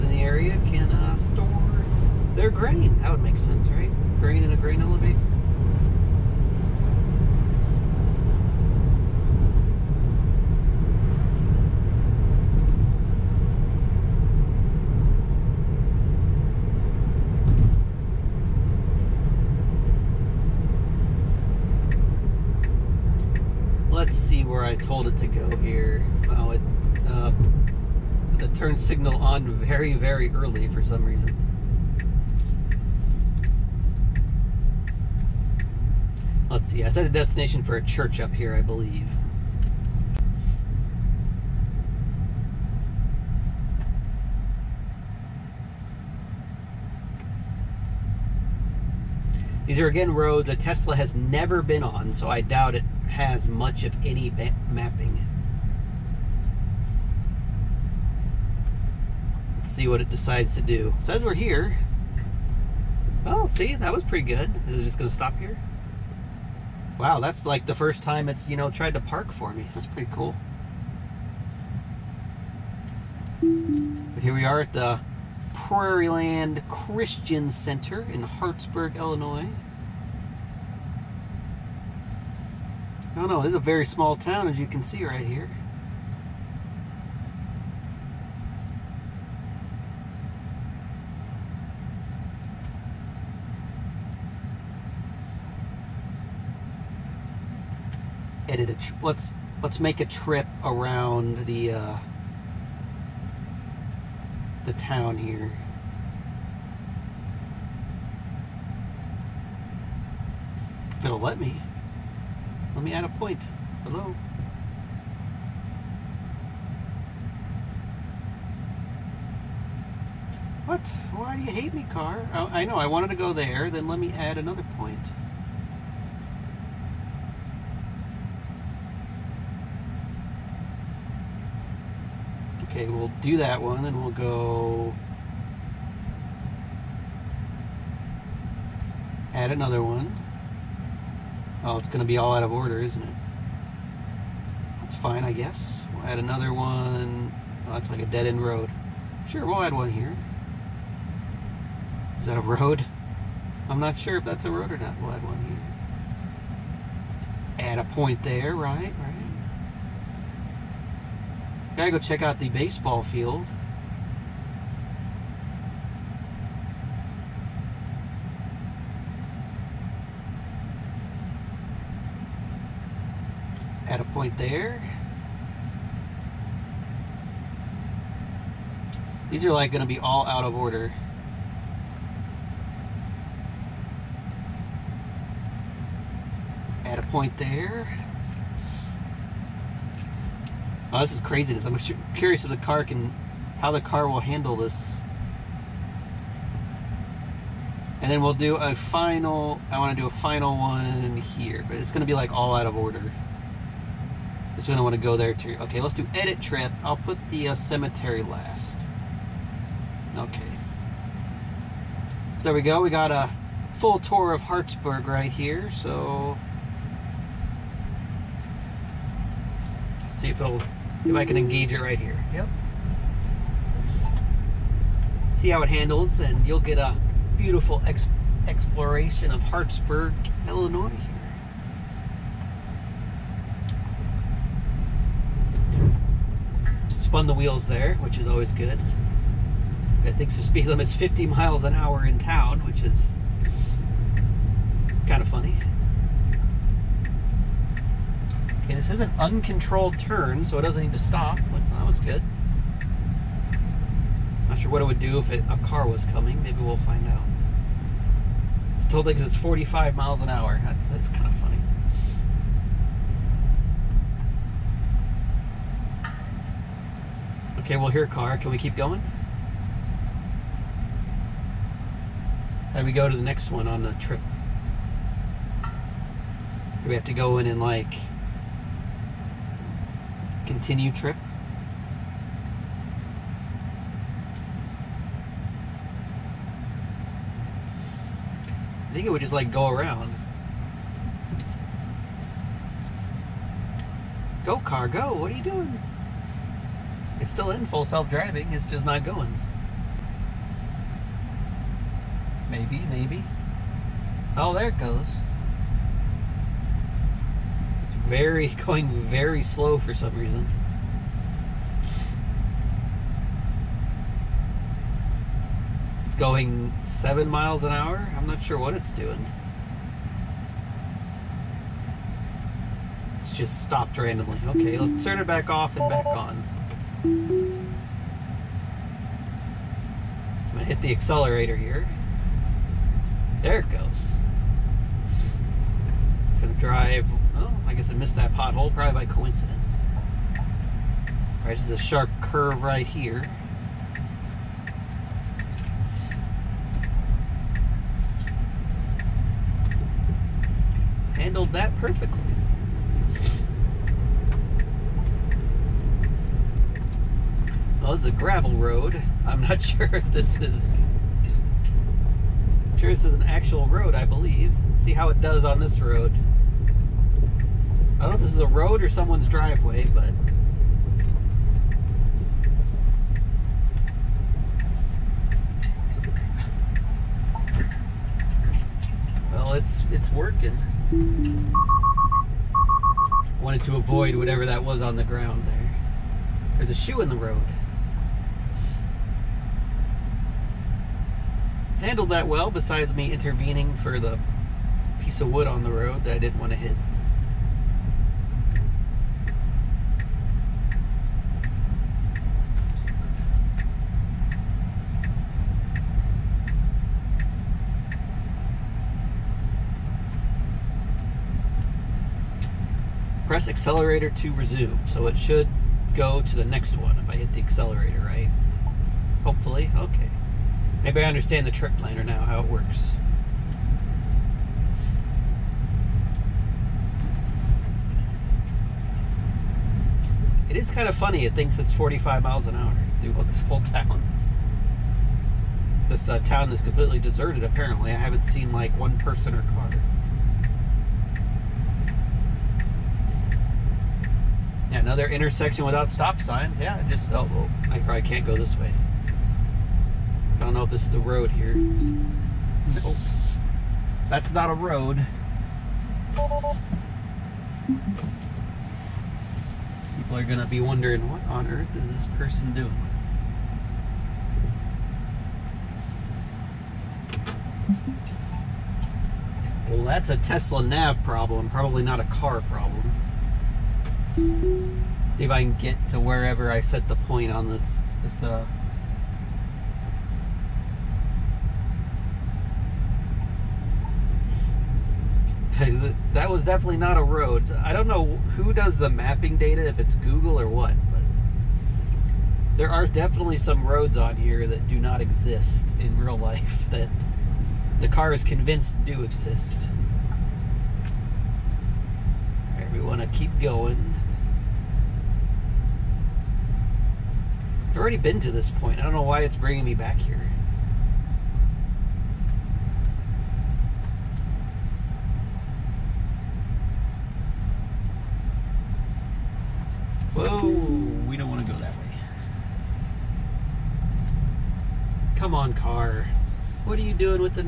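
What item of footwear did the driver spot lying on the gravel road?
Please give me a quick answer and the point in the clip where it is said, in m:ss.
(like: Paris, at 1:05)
shoe, at 6:26.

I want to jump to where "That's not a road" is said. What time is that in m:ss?
7:34.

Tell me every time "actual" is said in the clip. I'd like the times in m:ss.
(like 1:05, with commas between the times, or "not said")
6:03.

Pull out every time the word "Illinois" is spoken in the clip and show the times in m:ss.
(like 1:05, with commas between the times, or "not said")
1:18, 3:50.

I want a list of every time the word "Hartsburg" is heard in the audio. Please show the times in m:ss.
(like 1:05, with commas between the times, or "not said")
1:18, 3:34, 3:49.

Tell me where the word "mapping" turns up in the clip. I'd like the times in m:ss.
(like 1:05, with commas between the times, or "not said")
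0:54, 8:08.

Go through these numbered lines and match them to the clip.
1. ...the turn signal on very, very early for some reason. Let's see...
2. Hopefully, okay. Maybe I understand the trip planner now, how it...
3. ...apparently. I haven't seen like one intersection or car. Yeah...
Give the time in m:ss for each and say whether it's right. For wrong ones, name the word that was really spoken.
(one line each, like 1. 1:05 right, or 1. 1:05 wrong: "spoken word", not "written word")
1. 0:28 right
2. 6:59 right
3. 7:17 wrong: "person", not "intersection".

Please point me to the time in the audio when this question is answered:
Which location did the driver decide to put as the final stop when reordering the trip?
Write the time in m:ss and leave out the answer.
3:27.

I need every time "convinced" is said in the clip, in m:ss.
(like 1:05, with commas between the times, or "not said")
8:18.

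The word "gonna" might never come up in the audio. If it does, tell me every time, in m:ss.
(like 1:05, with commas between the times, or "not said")
2:59, 3:21, 5:30, 5:36, 7:40.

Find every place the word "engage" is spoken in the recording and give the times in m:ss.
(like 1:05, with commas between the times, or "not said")
3:41.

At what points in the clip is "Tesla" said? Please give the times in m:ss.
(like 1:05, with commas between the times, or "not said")
0:50, 7:50.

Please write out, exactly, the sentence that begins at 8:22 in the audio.
All right, we want to keep going.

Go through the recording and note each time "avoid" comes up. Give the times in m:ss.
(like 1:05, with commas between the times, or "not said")
6:23.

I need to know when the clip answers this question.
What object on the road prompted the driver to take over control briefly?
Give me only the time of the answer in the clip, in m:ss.
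6:35.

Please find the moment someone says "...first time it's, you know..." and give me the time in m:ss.
1:07.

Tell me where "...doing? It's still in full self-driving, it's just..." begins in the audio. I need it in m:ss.
4:55.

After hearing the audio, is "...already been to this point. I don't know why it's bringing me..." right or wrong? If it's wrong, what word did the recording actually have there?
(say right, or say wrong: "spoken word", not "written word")
right.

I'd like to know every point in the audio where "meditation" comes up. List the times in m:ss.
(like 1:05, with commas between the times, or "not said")
not said.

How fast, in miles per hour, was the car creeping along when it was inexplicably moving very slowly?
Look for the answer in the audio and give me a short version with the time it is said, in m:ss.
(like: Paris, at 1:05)
7, at 5:16.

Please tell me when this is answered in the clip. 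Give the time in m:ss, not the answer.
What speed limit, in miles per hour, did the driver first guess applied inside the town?
4:00.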